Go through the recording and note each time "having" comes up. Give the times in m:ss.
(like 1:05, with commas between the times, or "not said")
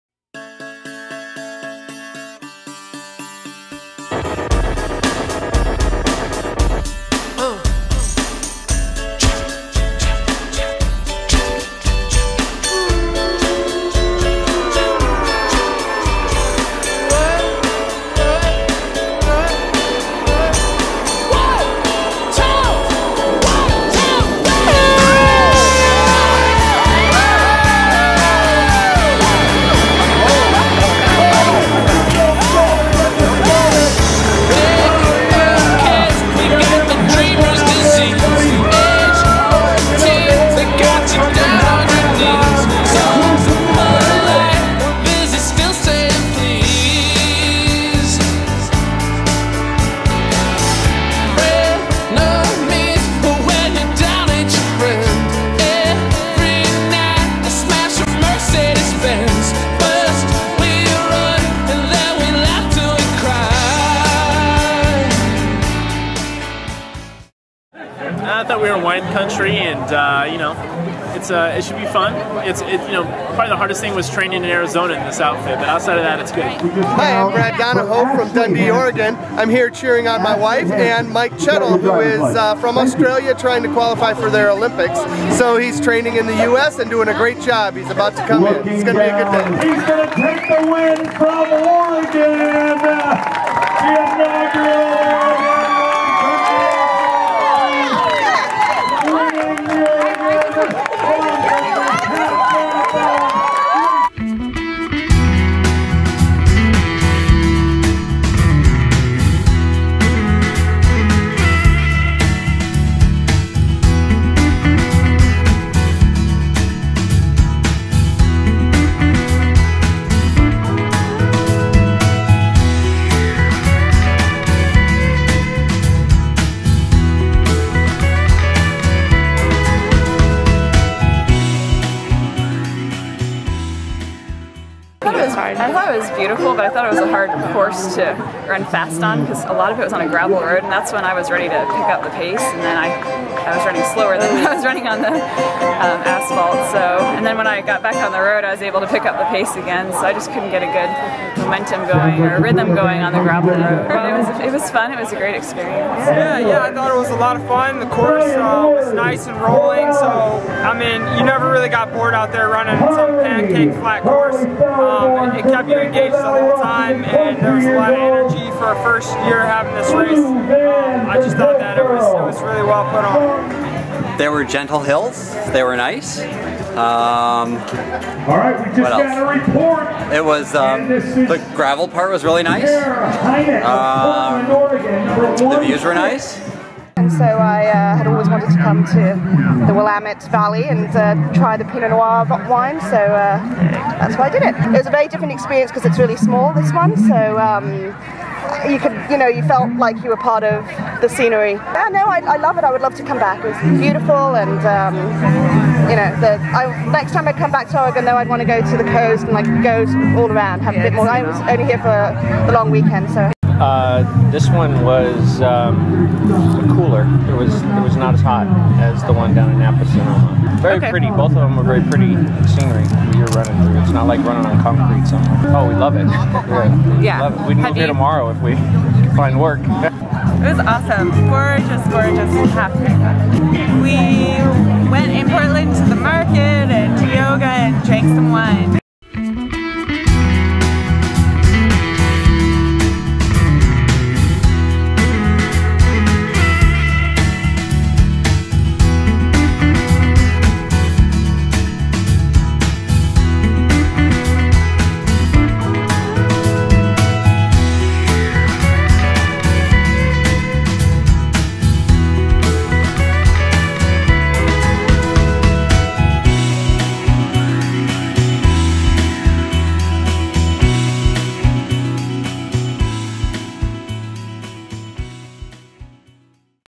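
2:49.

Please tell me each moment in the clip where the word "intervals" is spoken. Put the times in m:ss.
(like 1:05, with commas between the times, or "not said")
not said.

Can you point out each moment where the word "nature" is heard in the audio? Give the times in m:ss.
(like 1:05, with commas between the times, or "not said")
not said.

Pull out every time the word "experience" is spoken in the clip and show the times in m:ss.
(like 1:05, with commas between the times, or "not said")
2:35, 3:15.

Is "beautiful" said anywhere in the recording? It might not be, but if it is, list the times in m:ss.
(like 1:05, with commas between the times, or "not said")
2:16, 3:23.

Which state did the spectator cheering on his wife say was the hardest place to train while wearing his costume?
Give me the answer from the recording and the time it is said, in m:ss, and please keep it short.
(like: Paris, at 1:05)
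Arizona, at 1:14.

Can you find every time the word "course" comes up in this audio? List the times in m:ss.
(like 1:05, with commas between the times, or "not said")
2:17, 2:37, 2:44.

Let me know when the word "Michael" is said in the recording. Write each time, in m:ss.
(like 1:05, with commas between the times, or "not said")
not said.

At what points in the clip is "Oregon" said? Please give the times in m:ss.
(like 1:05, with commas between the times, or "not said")
1:18, 1:31, 3:27.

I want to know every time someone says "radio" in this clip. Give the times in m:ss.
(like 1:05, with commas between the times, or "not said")
not said.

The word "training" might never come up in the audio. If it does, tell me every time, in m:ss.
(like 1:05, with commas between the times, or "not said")
1:14, 1:25.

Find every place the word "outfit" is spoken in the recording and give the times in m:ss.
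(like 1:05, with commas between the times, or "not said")
1:15.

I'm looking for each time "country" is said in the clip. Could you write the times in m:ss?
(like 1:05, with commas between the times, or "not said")
1:09.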